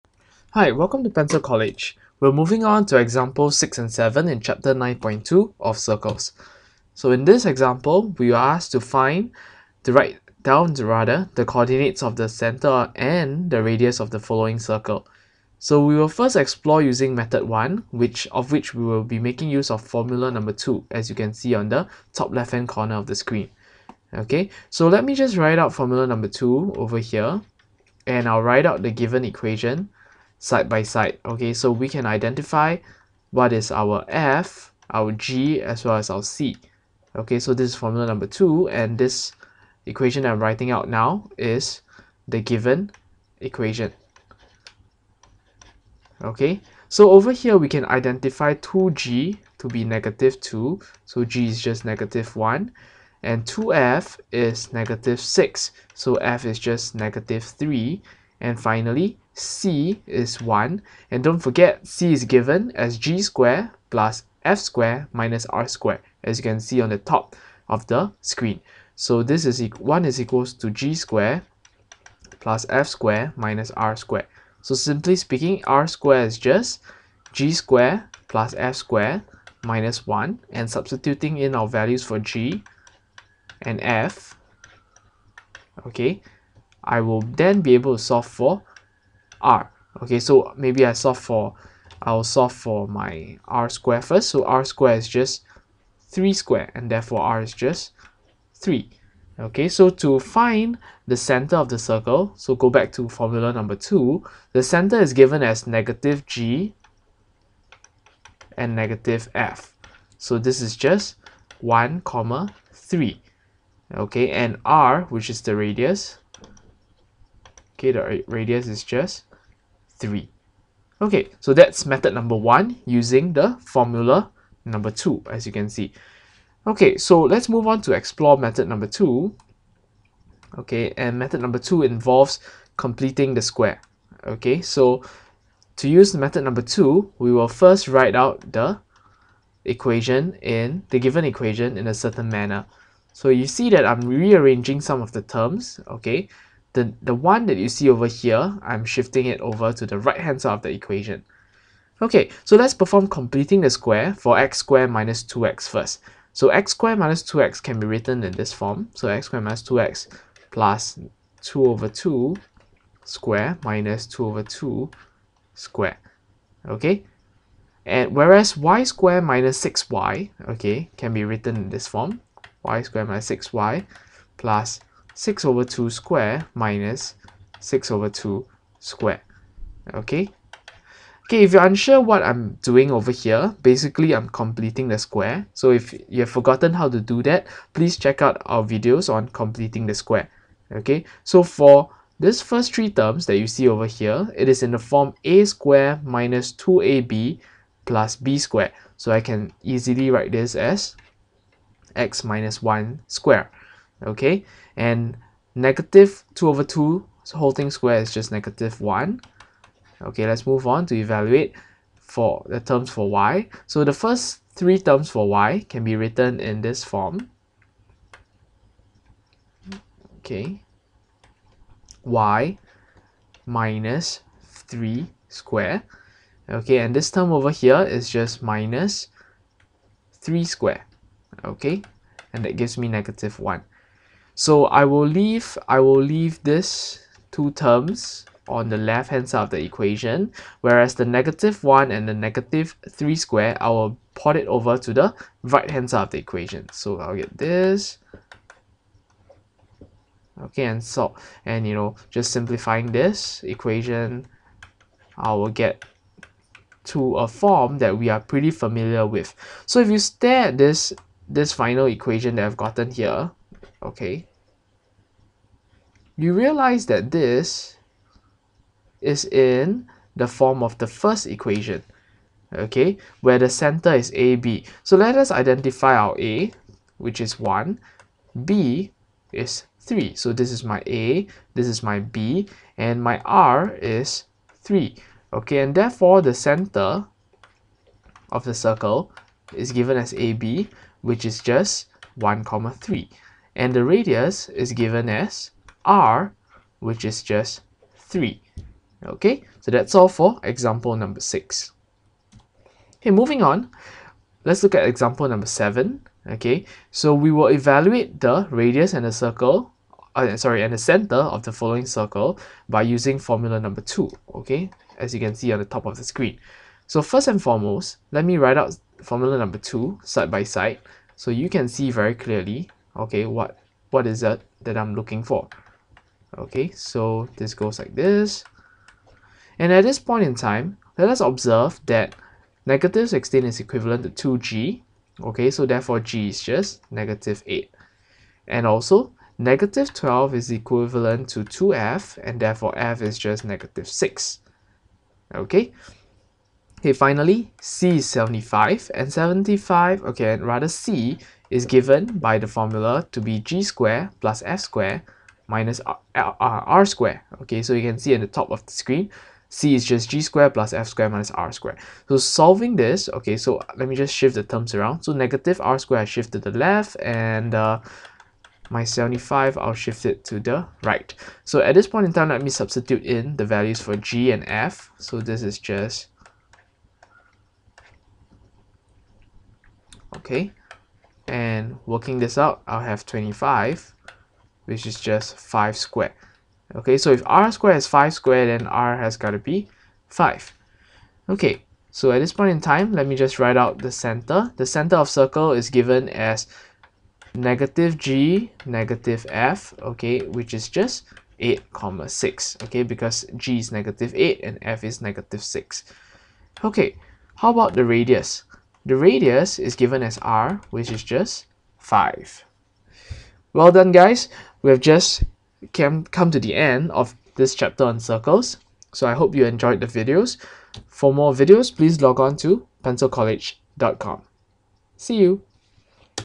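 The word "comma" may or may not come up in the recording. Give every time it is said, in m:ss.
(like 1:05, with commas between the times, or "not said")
1:52, 4:52, 6:41.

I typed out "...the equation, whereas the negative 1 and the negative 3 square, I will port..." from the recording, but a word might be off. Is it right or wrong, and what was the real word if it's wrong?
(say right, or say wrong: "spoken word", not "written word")
right.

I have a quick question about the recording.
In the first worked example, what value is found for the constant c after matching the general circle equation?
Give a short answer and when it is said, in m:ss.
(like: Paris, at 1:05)
1, at 0:59.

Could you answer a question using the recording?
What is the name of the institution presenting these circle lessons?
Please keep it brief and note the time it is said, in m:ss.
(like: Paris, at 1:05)
Pencil College, at 0:01.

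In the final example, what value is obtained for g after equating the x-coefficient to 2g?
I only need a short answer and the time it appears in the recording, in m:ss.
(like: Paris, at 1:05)
-8, at 5:35.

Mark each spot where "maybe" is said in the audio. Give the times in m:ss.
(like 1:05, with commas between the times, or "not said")
1:30.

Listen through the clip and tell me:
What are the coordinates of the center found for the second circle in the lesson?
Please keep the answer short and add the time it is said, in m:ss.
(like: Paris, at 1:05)
(8, 6), at 6:41.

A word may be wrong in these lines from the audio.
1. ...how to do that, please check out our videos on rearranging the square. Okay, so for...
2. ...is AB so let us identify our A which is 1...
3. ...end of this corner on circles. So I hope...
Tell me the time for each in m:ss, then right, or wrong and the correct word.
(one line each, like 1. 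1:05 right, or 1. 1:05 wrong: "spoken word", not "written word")
1. 3:06 wrong: "completing", not "rearranging"
2. 4:33 right
3. 6:56 wrong: "chapter", not "corner".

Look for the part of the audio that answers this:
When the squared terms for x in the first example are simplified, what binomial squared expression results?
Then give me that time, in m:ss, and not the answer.
3:21.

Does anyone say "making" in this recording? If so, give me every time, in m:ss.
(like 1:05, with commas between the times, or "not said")
0:19.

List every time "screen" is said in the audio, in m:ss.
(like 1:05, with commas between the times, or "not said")
0:23, 1:08, 5:16, 5:58.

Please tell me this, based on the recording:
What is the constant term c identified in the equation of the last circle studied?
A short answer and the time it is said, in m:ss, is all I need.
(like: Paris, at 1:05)
75, at 5:47.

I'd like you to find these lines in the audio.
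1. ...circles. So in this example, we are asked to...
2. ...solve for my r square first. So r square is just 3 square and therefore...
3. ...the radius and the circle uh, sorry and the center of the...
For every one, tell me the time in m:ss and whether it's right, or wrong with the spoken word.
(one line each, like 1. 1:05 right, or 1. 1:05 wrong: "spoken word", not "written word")
1. 0:05 right
2. 1:32 right
3. 5:08 right.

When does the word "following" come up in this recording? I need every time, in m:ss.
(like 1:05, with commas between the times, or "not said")
0:14, 5:11.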